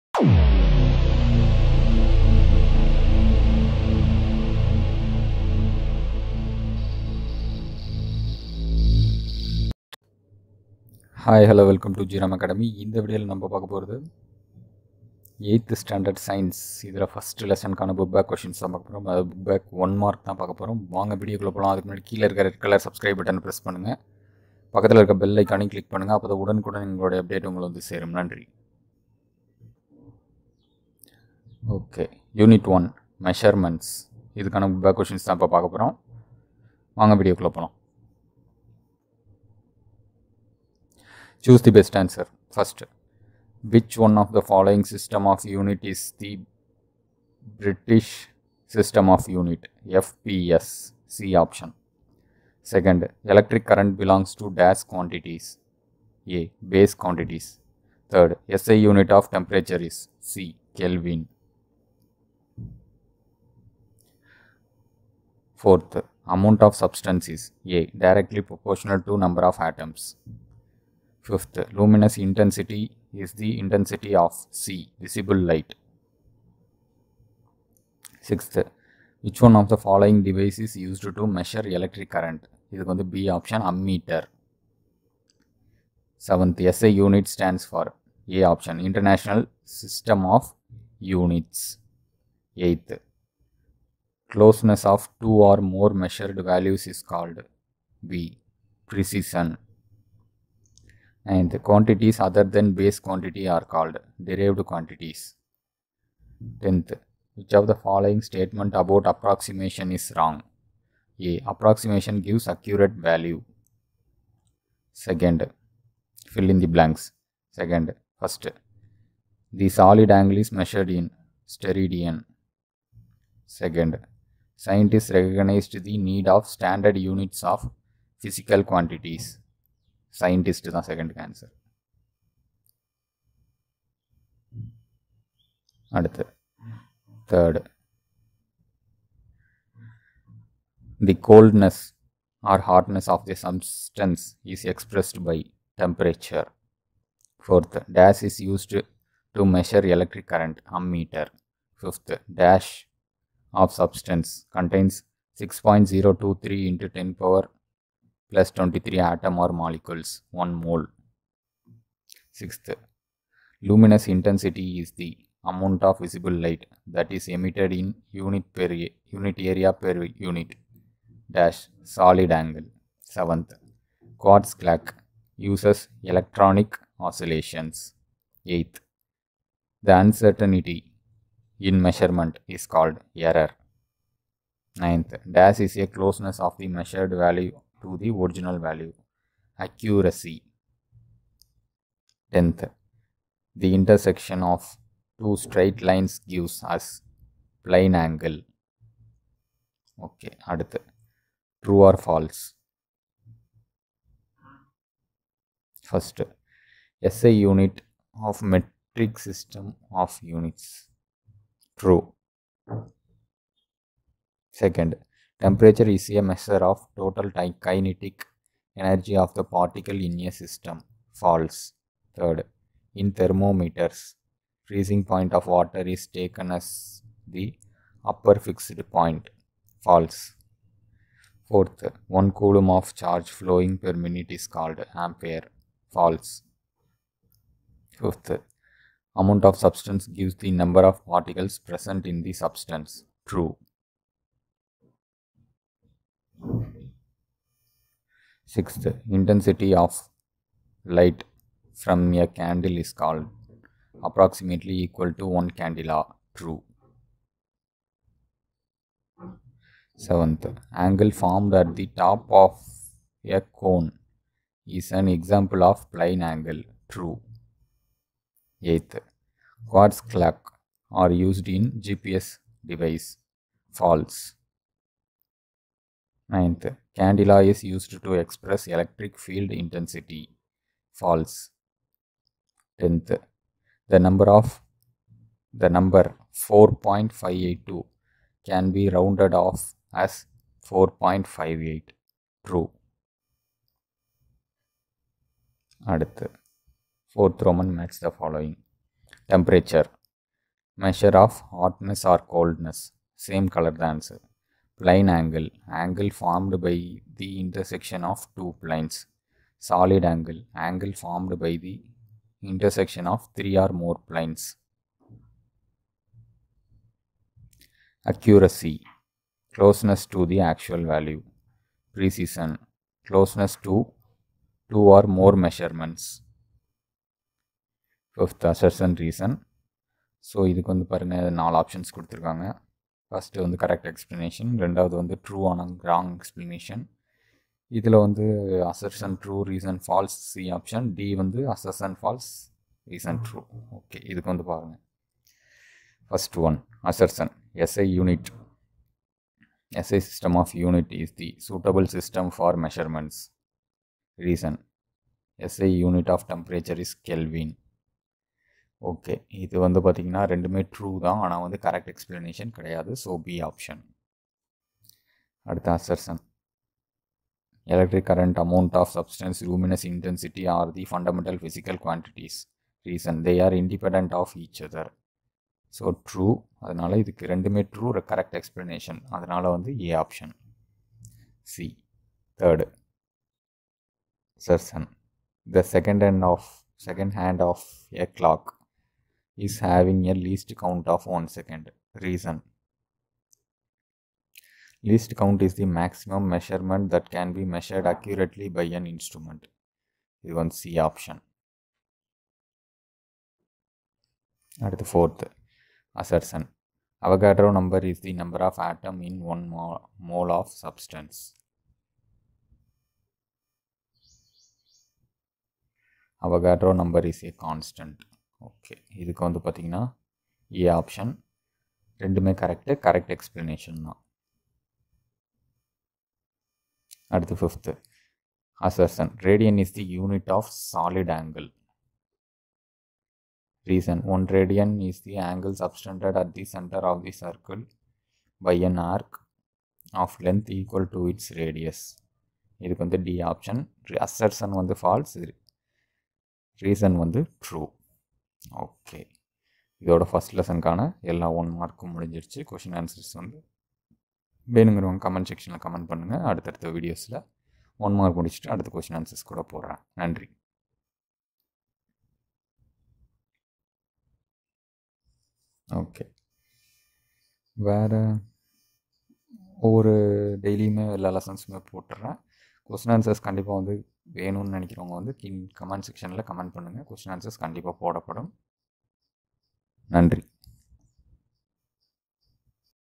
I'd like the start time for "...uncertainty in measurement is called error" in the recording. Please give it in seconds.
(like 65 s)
180 s.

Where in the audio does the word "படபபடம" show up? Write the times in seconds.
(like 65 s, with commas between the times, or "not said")
477 s.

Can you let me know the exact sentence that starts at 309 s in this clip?
Solid angle, angle formed by the intersection of three or more planes.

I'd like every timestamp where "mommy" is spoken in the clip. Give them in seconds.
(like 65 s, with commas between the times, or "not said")
not said.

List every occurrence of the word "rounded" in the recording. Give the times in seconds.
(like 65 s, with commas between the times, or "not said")
288 s.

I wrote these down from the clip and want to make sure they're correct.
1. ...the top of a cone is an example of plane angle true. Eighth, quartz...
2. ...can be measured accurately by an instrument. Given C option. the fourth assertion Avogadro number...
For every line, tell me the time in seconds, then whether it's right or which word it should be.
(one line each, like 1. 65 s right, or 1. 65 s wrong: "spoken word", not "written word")
1. 261 s right
2. 397 s right.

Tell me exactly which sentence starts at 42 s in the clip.
First, which one of the following system of unit is the British system of unit?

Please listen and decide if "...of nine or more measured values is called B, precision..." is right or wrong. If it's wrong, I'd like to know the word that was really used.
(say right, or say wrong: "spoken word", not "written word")
wrong: "two", not "nine".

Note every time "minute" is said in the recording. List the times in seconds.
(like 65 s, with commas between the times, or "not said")
233 s.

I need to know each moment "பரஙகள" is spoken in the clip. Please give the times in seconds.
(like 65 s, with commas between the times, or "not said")
330 s, 344 s.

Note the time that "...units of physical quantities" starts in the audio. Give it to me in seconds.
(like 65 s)
126 s.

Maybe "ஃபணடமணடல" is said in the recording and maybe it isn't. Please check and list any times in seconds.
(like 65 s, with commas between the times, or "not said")
370 s.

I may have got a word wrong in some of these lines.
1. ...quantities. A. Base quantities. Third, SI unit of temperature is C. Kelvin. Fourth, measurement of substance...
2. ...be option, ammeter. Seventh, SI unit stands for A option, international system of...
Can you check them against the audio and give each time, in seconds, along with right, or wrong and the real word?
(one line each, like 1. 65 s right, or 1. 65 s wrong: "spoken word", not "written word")
1. 54 s wrong: "amount", not "measurement"
2. 83 s right.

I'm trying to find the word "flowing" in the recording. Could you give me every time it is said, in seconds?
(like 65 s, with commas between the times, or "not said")
233 s.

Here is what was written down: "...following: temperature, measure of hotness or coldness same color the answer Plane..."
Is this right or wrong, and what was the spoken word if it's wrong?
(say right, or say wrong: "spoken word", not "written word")
right.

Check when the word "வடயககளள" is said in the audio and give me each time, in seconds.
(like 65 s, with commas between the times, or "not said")
21 s, 37 s.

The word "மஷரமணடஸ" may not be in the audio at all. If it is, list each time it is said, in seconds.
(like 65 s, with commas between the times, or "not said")
33 s, 352 s.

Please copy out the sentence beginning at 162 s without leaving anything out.
Sixth, luminous intensity is the amount of visible light that is emitted in unit per unit area per unit dash solid angle.